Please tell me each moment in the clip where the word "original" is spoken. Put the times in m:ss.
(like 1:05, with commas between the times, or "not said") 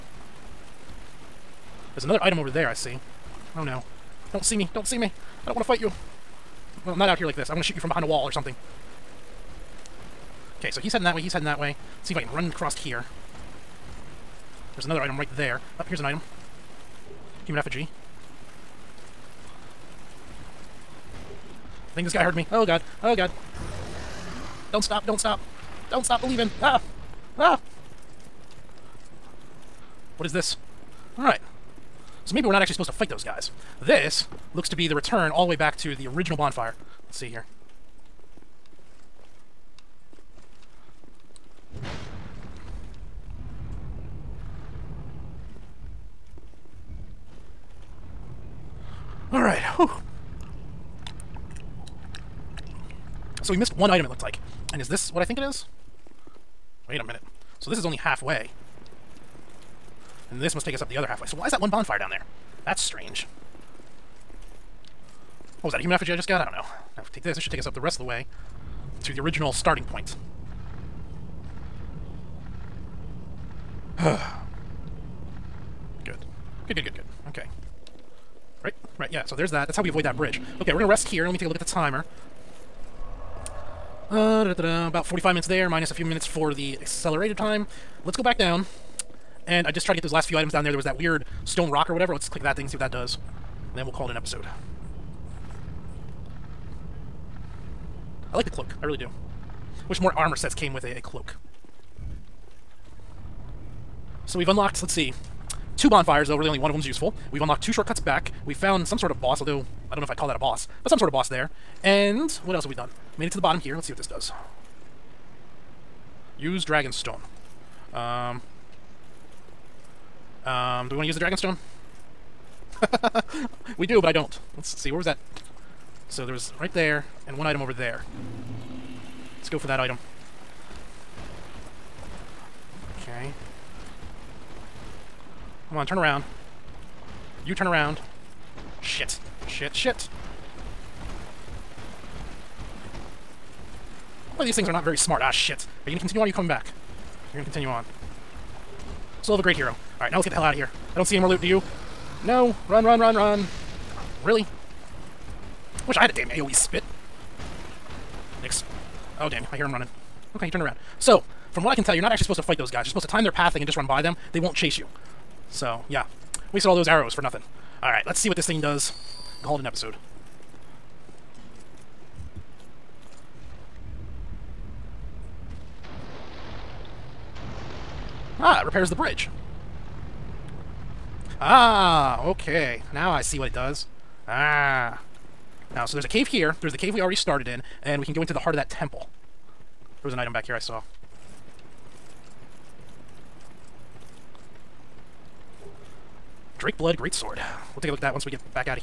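0:36, 1:09.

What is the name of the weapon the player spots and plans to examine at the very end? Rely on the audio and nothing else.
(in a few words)
Drake Blood Greatsword.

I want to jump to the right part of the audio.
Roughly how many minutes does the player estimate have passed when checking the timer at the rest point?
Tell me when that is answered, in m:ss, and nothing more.
1:25.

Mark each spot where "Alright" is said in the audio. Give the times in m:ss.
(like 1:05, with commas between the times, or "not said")
0:31, 2:29, 2:47.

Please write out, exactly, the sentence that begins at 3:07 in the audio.
And we can go into the heart of that temple.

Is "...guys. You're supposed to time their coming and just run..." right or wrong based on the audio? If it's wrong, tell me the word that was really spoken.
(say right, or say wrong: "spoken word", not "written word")
wrong: "pathing", not "coming".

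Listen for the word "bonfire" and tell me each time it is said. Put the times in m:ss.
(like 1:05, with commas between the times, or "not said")
0:36, 1:01, 1:45.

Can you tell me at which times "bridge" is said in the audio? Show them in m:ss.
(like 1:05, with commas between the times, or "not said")
1:20, 2:58.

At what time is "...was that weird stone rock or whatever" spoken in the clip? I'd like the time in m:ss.
1:30.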